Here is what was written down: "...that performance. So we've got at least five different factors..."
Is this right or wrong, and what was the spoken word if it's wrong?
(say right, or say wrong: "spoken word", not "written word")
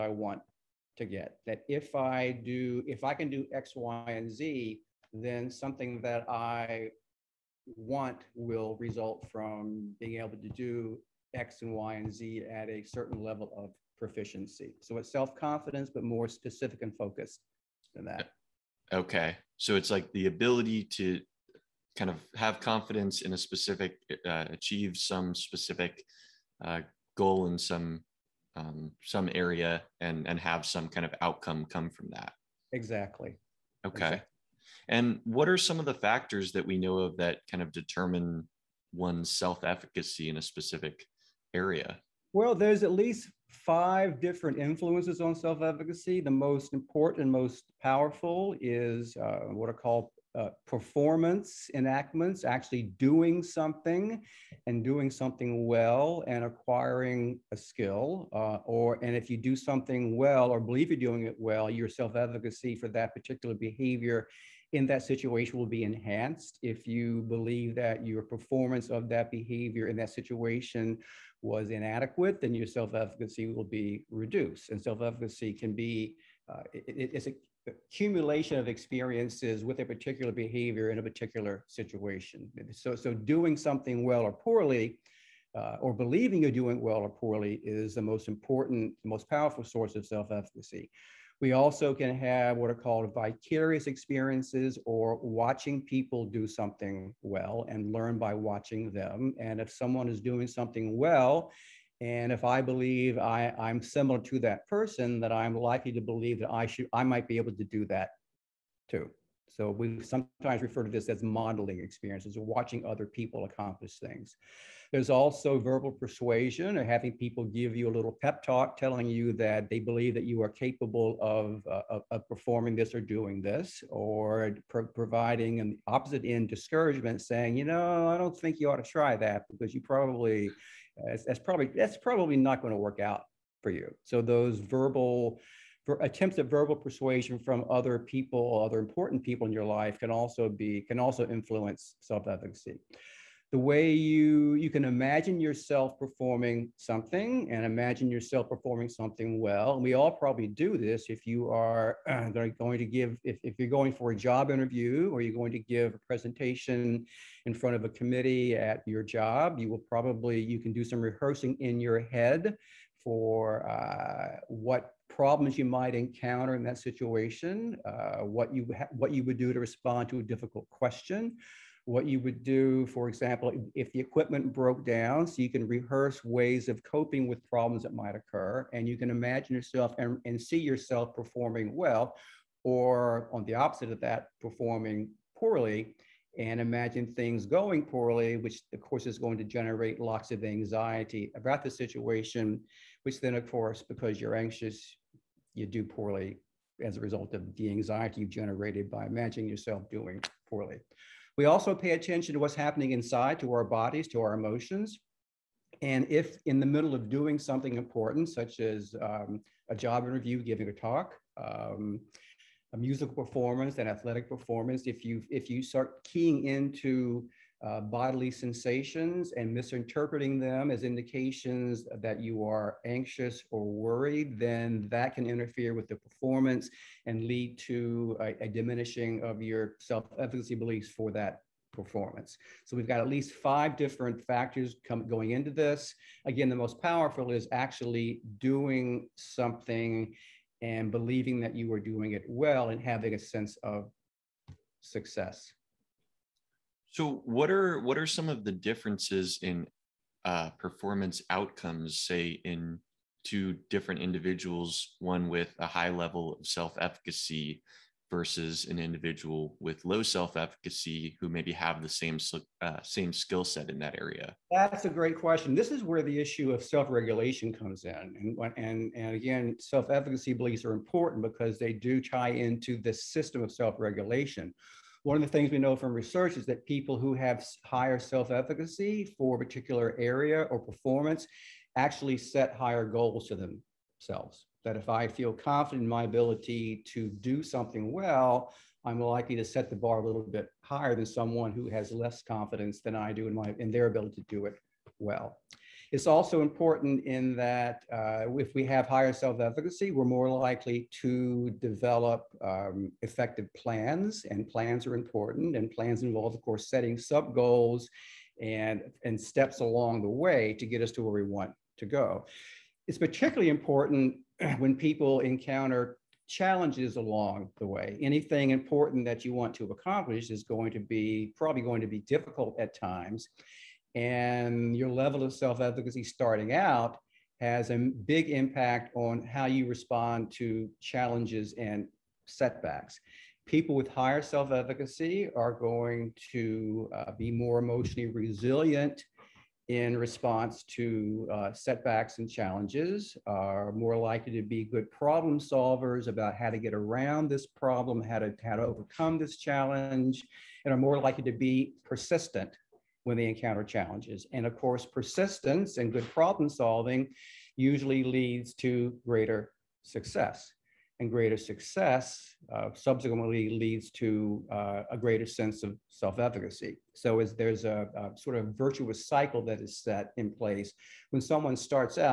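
right.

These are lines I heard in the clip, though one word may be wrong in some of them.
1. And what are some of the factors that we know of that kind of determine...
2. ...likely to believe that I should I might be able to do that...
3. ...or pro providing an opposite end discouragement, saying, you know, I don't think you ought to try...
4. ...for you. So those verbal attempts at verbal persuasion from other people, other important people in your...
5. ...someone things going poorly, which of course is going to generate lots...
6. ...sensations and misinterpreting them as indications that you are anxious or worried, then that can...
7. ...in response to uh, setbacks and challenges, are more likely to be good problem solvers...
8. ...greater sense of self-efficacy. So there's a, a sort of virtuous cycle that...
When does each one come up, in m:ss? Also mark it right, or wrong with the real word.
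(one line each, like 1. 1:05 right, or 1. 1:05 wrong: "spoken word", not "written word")
1. 0:34 right
2. 1:45 right
3. 2:03 right
4. 2:13 right
5. 3:06 wrong: "imagine", not "someone"
6. 3:38 right
7. 5:39 right
8. 6:04 right.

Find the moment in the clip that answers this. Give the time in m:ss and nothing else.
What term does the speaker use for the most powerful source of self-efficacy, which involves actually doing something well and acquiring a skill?
0:50.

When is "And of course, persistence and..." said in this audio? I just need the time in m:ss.
5:54.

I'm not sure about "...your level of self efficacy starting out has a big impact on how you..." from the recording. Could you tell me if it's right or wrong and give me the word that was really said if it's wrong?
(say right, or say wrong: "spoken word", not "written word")
right.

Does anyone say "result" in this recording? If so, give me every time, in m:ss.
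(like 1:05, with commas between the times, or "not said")
0:08, 3:16.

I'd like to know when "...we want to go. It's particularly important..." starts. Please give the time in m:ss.
5:11.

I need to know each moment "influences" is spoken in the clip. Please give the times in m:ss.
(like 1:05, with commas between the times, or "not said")
0:44, 2:21.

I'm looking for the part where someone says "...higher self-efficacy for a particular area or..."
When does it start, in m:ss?
4:37.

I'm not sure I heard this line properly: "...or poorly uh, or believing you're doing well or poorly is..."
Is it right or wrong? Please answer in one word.
right.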